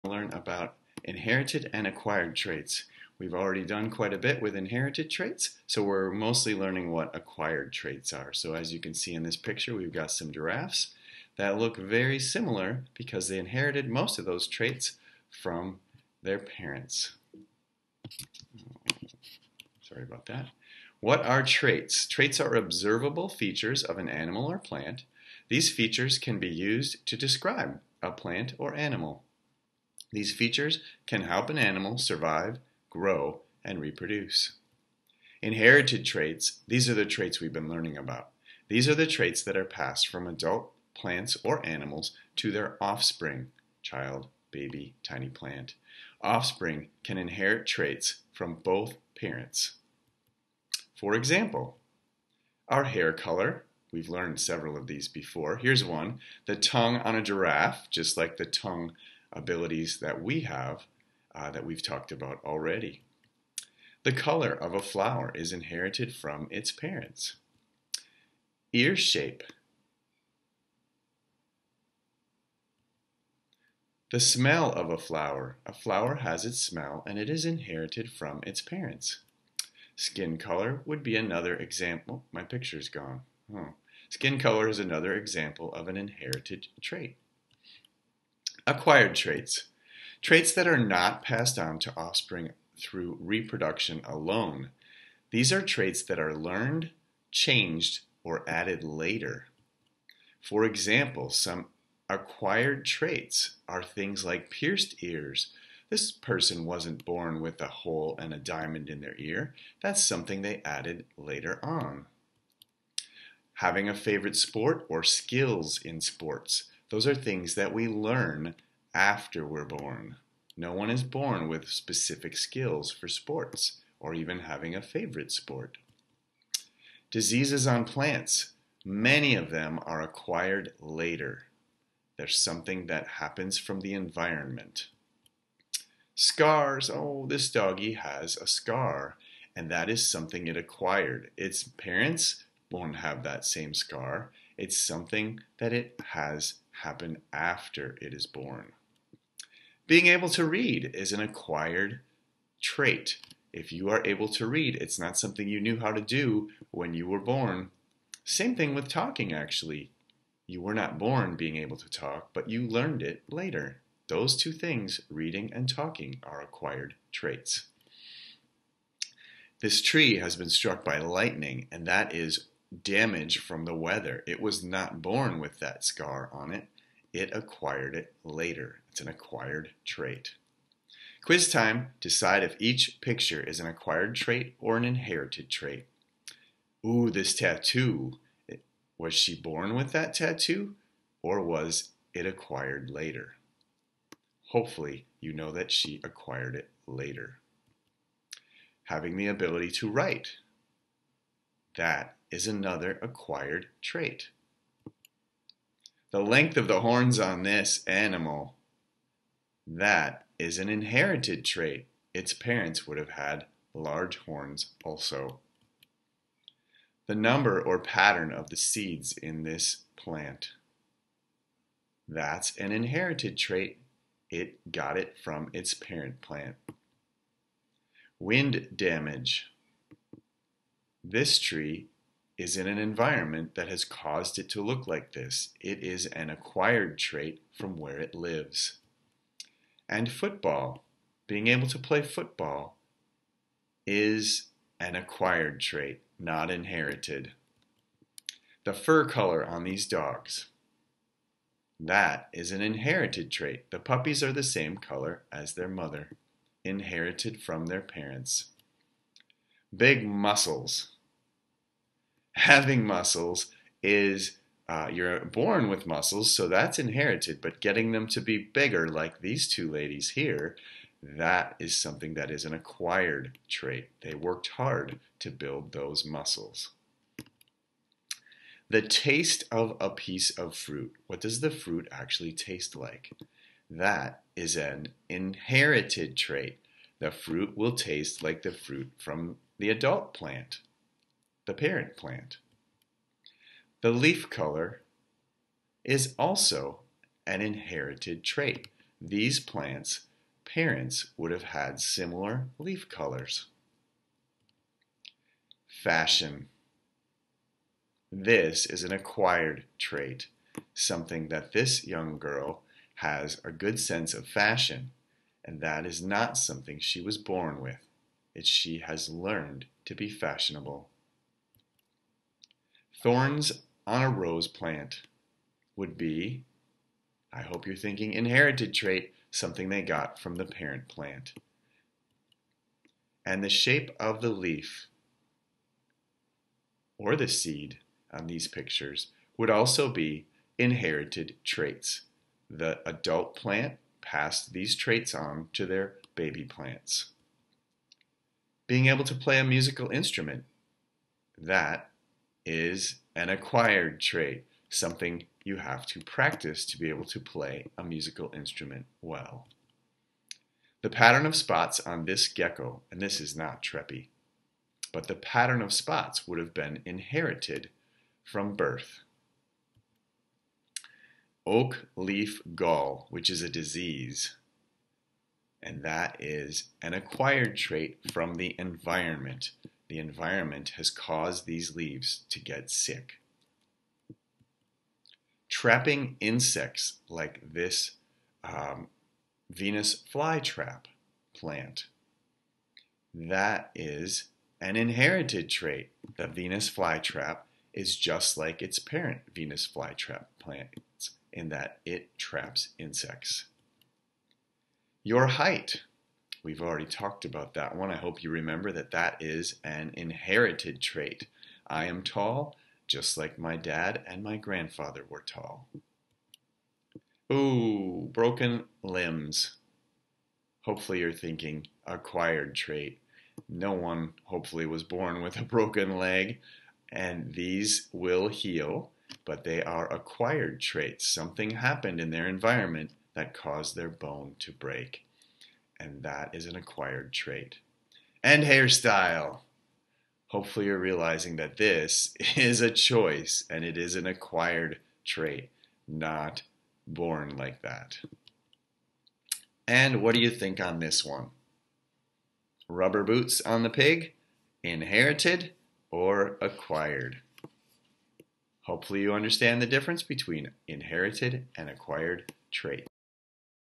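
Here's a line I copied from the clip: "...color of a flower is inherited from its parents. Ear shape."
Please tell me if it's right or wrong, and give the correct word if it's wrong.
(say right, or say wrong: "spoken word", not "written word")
right.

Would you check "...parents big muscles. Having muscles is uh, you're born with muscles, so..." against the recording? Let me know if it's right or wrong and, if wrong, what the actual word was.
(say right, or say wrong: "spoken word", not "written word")
right.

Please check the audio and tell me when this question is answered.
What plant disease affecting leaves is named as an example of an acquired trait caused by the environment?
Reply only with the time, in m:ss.
6:11.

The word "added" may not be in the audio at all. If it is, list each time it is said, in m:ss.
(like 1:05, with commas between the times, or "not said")
1:38, 1:50.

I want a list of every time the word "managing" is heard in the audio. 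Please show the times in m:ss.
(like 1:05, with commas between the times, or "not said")
not said.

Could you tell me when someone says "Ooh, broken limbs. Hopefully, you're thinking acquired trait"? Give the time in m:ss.
6:57.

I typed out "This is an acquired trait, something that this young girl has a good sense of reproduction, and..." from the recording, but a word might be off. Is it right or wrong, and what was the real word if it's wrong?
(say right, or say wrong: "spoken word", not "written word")
wrong: "fashion", not "reproduction".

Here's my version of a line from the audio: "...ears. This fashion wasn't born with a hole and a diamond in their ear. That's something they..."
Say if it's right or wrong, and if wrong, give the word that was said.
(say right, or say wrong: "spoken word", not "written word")
wrong: "person", not "fashion".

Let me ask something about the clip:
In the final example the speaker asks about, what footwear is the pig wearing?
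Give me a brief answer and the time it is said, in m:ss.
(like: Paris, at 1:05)
Rubber boots, at 7:32.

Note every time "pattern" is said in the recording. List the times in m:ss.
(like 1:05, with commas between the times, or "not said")
3:37, 6:00, 6:05.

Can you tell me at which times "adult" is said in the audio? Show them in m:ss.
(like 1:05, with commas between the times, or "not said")
0:40, 4:49, 5:42.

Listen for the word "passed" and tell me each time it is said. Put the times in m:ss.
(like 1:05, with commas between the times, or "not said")
0:39, 1:31, 5:44.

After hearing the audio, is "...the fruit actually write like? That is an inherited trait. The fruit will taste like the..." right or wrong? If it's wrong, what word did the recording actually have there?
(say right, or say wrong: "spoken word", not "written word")
wrong: "taste", not "write".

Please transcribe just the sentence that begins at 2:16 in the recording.
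Scars, oh, this doggy has a scar, and that is something it acquired.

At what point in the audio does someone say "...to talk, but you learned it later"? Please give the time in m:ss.
2:41.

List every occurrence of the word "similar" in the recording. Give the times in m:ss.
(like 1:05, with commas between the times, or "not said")
0:12, 5:01.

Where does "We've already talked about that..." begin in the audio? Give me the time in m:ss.
6:46.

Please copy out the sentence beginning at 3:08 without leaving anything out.
Was she born with that tattoo or was it acquired later?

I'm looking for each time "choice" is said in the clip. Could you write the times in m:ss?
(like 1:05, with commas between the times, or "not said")
7:22.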